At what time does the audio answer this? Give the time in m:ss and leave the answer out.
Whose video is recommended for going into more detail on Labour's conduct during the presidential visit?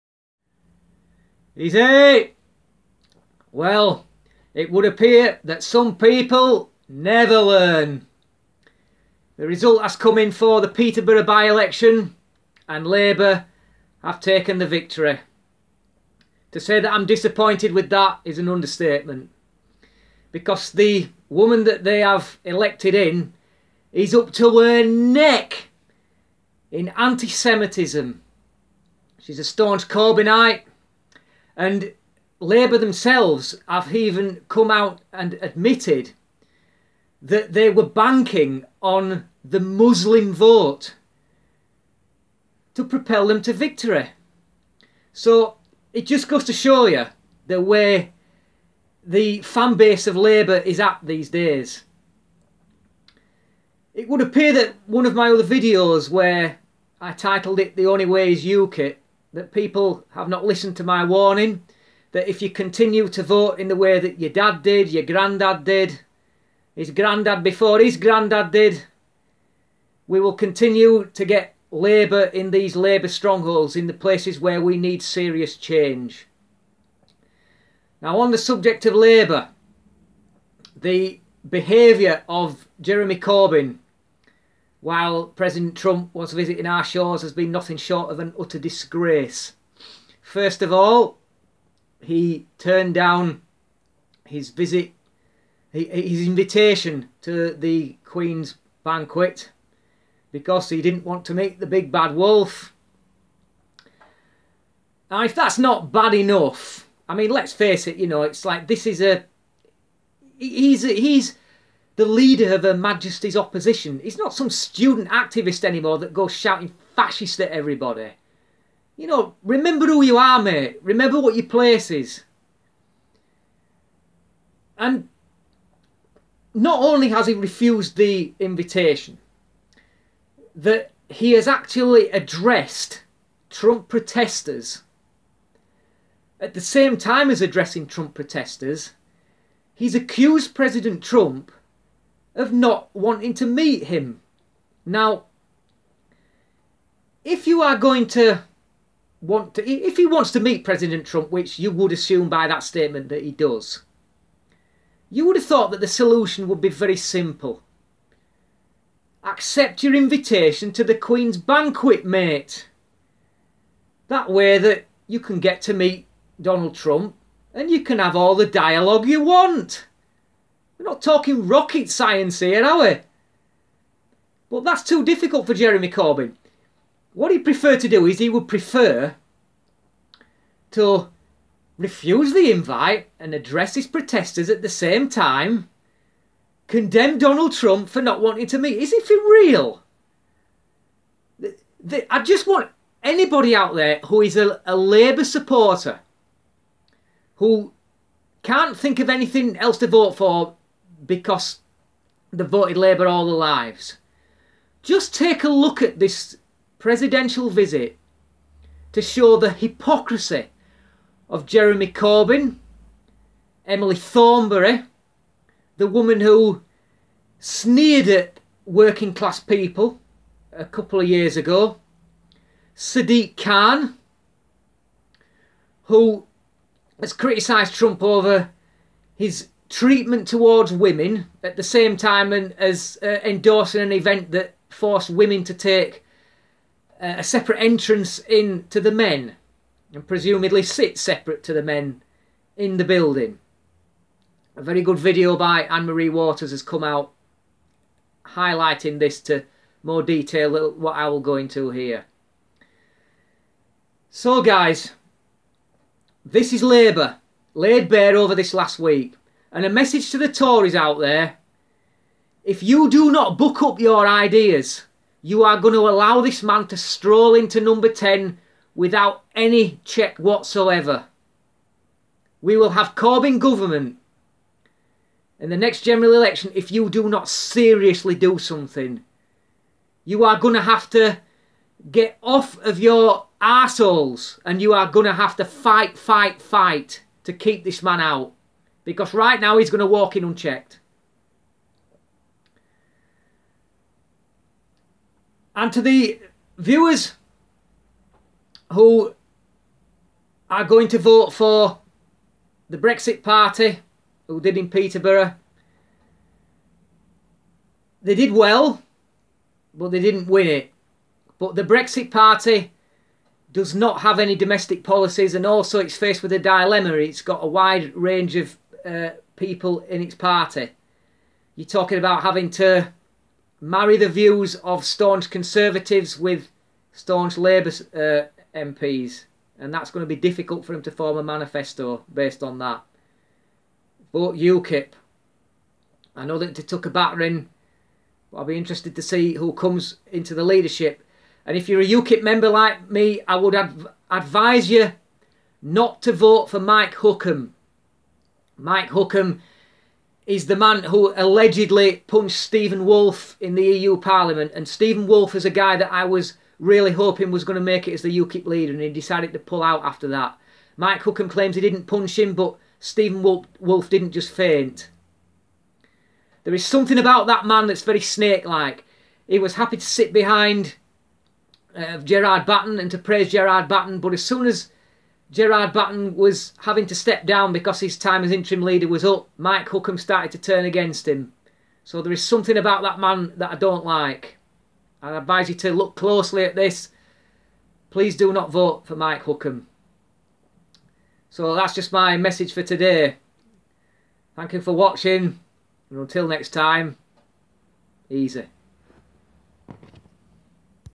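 4:05.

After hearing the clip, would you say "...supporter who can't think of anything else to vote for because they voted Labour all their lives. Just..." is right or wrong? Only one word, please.
right.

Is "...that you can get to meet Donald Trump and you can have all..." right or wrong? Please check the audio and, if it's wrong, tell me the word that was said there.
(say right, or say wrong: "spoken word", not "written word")
right.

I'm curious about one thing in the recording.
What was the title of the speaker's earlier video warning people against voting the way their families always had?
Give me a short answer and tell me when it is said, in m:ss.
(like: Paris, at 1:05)
The Only Way is UKIP, at 0:57.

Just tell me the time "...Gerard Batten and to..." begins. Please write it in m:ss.
6:11.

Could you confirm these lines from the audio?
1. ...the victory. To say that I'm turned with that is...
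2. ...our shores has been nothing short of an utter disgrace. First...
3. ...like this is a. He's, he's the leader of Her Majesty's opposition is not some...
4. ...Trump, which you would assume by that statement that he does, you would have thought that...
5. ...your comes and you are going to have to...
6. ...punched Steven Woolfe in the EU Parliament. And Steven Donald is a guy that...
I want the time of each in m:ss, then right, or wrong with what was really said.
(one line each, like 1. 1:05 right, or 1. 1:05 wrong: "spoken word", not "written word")
1. 0:14 wrong: "disappointed", not "turned"
2. 1:26 right
3. 1:48 right
4. 2:31 right
5. 4:42 wrong: "arseholes", not "comes"
6. 5:52 wrong: "Woolfe", not "Donald".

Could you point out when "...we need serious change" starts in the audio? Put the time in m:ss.
1:14.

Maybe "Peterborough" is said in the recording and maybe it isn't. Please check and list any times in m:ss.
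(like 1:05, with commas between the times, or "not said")
0:10, 5:04.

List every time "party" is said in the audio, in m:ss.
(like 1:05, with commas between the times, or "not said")
5:03, 5:12, 5:20.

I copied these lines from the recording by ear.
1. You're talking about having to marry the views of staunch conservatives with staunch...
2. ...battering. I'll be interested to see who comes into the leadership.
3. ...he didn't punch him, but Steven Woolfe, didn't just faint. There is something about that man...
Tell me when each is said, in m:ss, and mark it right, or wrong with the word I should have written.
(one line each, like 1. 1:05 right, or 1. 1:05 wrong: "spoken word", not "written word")
1. 5:21 right
2. 5:36 right
3. 6:01 right.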